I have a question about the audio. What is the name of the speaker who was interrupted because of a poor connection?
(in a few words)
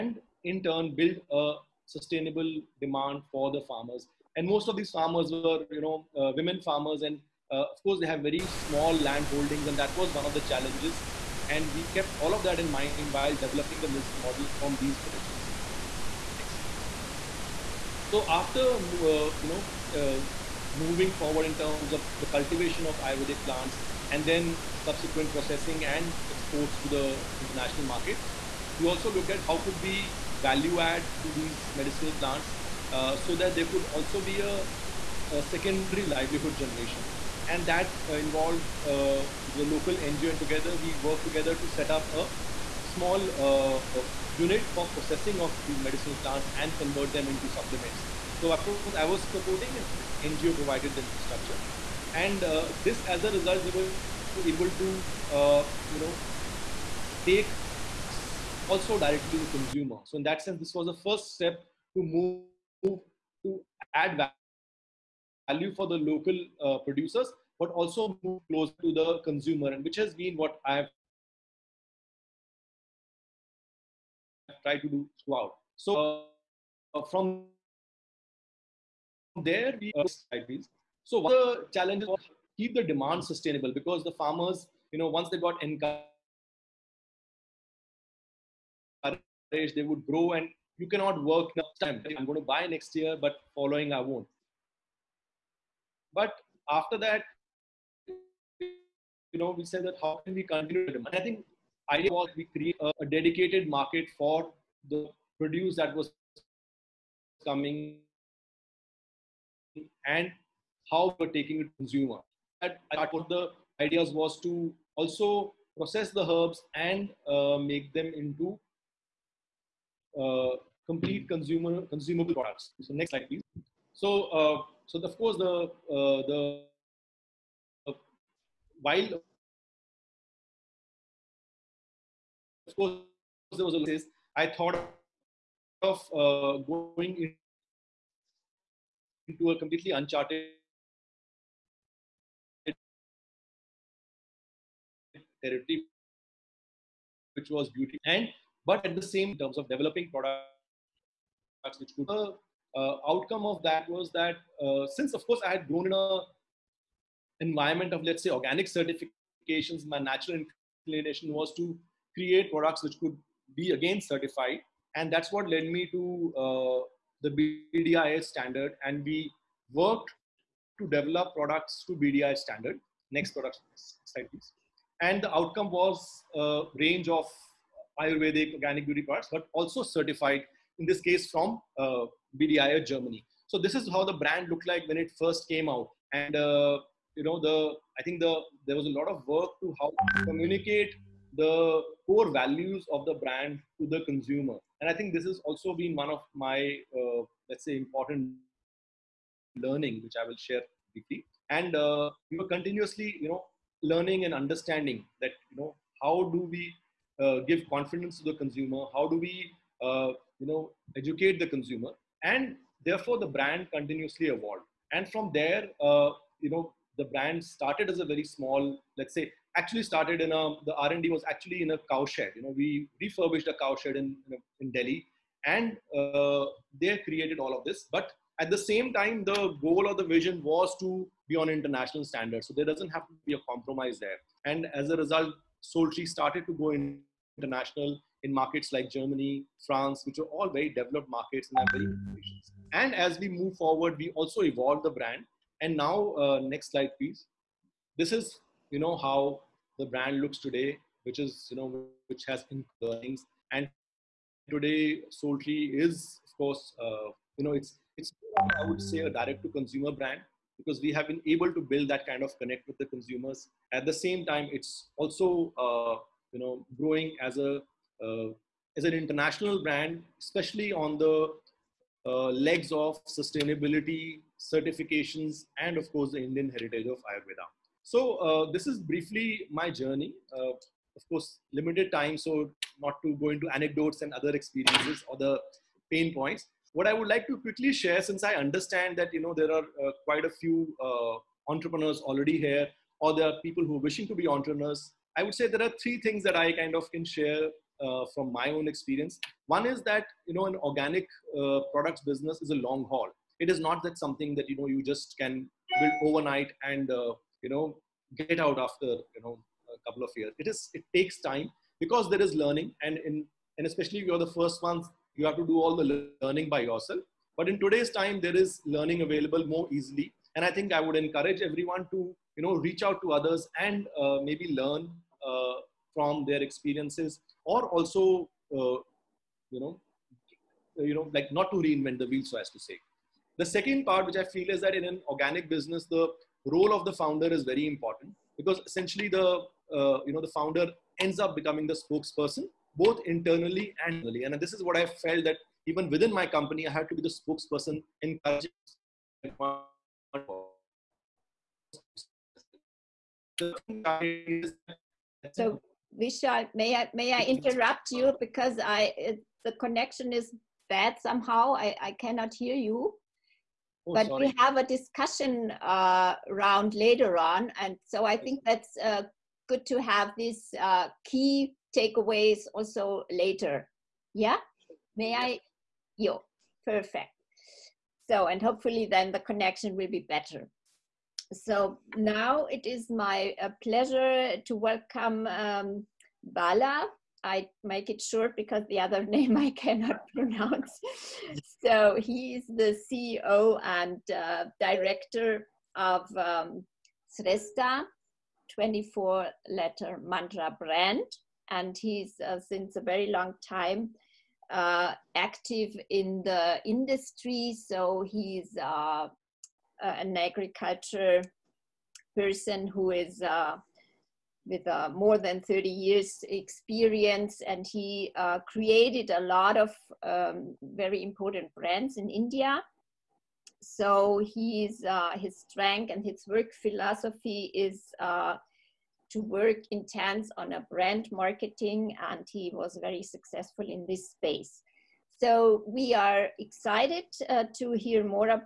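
Vishal.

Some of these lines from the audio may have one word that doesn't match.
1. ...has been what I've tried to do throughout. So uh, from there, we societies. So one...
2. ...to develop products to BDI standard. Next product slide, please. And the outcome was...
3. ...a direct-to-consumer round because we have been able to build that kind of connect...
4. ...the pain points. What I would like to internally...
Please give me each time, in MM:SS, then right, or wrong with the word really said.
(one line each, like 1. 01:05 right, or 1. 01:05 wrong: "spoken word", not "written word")
1. 01:09 right
2. 02:50 right
3. 04:18 wrong: "brand", not "round"
4. 04:45 wrong: "quickly", not "internally".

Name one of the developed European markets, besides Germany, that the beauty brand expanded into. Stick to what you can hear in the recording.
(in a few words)
France.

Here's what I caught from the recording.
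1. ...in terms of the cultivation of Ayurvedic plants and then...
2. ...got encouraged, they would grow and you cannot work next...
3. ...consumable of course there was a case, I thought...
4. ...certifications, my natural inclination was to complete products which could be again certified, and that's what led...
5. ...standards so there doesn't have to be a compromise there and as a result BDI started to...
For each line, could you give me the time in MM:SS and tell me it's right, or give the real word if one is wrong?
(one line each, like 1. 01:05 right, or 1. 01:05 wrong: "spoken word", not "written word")
1. 00:21 right
2. 01:25 right
3. 02:08 wrong: "while", not "consumable"
4. 02:38 wrong: "create", not "complete"
5. 03:52 wrong: "SoulTree", not "BDI".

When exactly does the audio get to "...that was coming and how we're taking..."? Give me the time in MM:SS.
01:45.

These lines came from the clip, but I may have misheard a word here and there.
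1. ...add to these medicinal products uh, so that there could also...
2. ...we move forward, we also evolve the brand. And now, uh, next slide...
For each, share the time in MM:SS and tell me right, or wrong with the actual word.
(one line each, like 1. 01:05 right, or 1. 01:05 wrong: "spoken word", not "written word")
1. 00:30 wrong: "plants", not "products"
2. 04:03 right.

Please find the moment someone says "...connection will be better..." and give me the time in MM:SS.
06:19.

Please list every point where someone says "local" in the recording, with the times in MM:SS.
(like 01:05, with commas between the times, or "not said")
00:39, 01:05.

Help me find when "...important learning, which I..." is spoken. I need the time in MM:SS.
03:17.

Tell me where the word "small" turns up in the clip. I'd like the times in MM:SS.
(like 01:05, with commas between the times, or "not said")
00:08, 00:42, 03:38.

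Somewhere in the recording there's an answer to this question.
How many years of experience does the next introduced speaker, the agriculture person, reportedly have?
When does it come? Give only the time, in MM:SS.
06:54.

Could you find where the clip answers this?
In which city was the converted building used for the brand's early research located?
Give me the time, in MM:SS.
03:44.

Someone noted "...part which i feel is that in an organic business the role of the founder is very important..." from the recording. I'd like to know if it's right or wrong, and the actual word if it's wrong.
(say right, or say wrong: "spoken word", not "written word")
right.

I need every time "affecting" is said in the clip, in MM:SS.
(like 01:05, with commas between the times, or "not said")
not said.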